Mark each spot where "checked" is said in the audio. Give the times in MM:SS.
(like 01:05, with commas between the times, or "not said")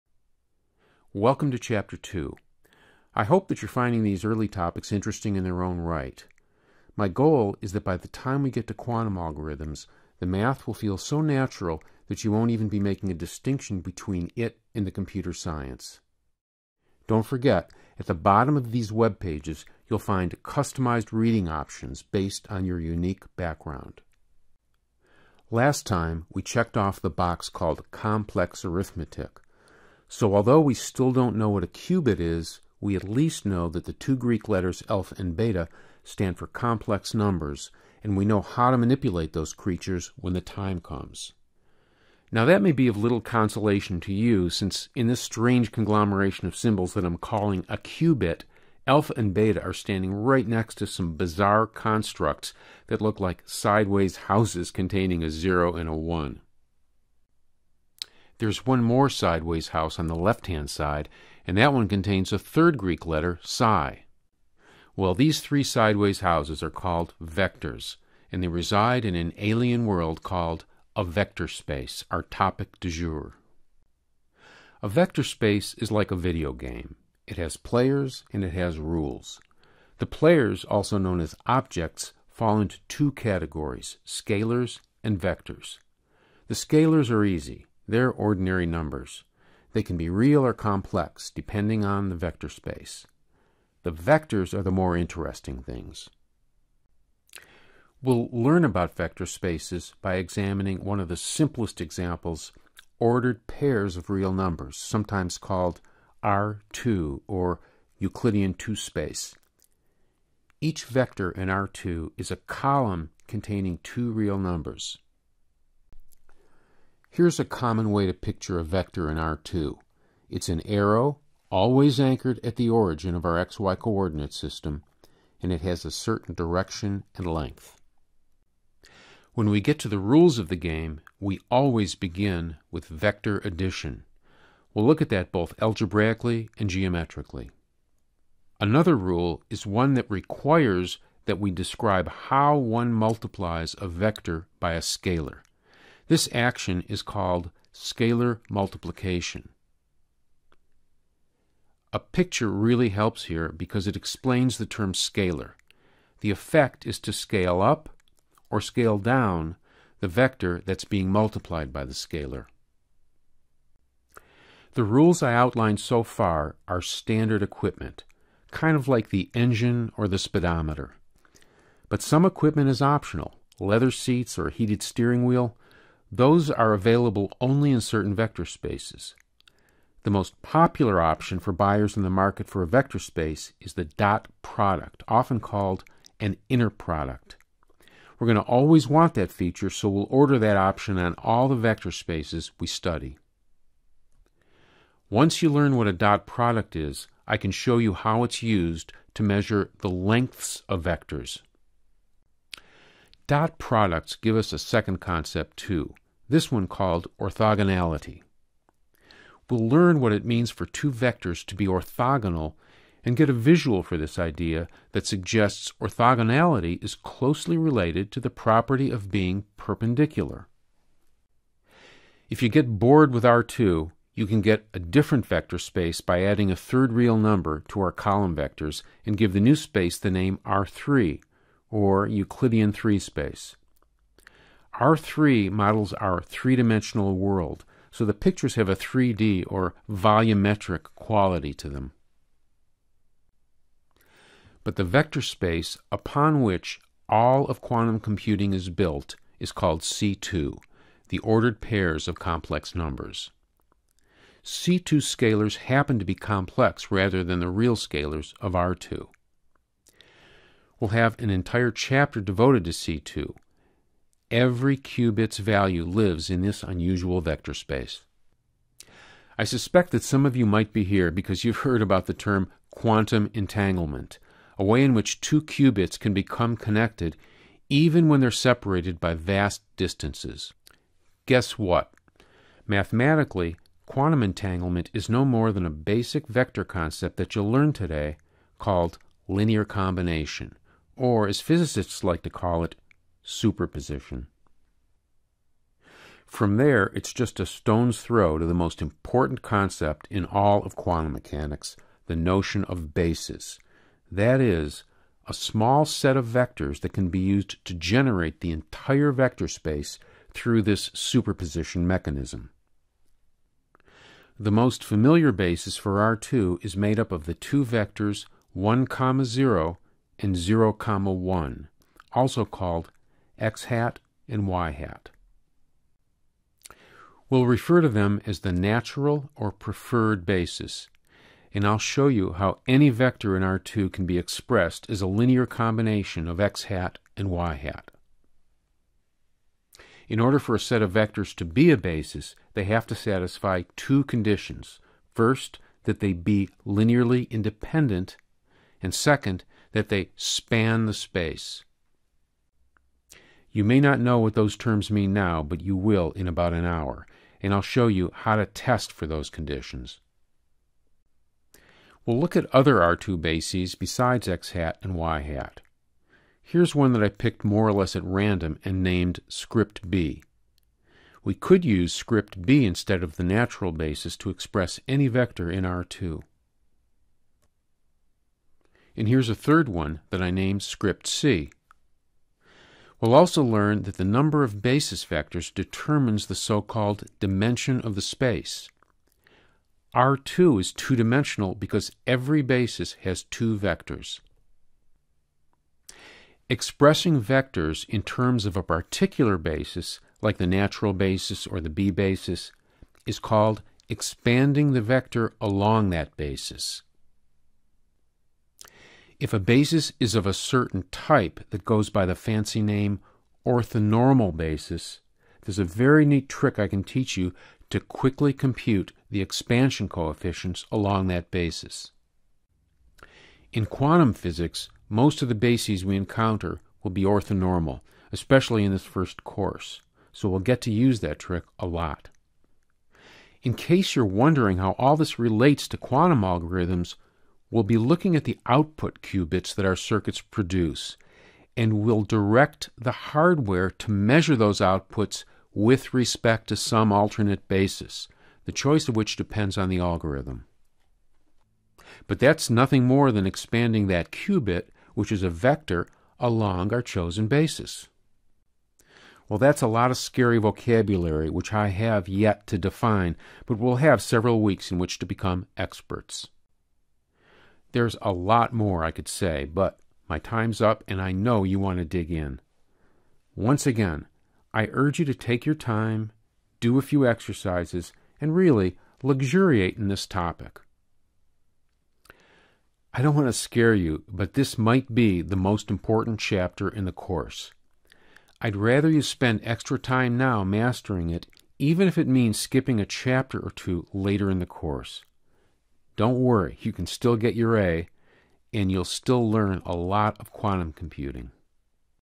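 00:26.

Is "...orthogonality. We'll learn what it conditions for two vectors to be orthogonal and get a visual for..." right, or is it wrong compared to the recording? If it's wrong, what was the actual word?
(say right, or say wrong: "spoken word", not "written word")
wrong: "means", not "conditions".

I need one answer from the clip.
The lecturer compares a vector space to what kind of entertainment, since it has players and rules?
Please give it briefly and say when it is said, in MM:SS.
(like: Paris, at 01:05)
a video game, at 01:16.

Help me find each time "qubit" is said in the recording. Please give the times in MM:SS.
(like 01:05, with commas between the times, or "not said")
00:31, 00:47, 04:24, 04:35, 07:19, 07:34.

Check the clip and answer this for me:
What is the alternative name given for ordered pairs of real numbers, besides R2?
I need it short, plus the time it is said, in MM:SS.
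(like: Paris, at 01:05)
Euclidean 2 space, at 01:47.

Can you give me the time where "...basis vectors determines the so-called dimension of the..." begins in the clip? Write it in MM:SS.
06:24.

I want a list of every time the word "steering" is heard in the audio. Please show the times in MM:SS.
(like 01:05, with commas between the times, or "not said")
02:54.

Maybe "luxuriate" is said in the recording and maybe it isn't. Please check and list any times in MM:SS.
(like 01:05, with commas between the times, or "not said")
07:59.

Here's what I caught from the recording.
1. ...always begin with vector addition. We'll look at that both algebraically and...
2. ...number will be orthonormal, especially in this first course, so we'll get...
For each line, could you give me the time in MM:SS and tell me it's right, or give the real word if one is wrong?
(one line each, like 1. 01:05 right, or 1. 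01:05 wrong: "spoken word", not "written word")
1. 02:11 right
2. 07:05 wrong: "encounter", not "number".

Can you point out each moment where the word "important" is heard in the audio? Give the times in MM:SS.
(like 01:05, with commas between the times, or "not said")
04:58, 08:05.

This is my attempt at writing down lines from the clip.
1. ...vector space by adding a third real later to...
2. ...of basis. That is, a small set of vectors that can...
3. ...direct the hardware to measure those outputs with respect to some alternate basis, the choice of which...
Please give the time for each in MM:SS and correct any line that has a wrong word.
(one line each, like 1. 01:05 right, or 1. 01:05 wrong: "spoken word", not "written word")
1. 03:45 wrong: "number", not "later"
2. 05:02 right
3. 07:22 right.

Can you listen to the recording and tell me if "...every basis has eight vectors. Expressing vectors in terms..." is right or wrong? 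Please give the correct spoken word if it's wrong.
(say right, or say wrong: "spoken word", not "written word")
wrong: "two", not "eight".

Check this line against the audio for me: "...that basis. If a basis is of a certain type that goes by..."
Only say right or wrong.
right.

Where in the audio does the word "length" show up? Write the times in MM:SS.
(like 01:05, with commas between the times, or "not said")
02:07, 03:19.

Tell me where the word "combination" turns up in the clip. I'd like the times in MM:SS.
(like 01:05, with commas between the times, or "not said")
04:49, 05:35.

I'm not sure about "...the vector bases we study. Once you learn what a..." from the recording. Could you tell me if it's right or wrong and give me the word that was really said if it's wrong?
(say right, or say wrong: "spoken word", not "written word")
wrong: "spaces", not "bases".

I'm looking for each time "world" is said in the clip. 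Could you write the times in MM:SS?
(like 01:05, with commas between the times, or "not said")
01:09, 03:57.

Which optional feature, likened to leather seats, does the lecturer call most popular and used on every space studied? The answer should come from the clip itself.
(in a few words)
the dot product.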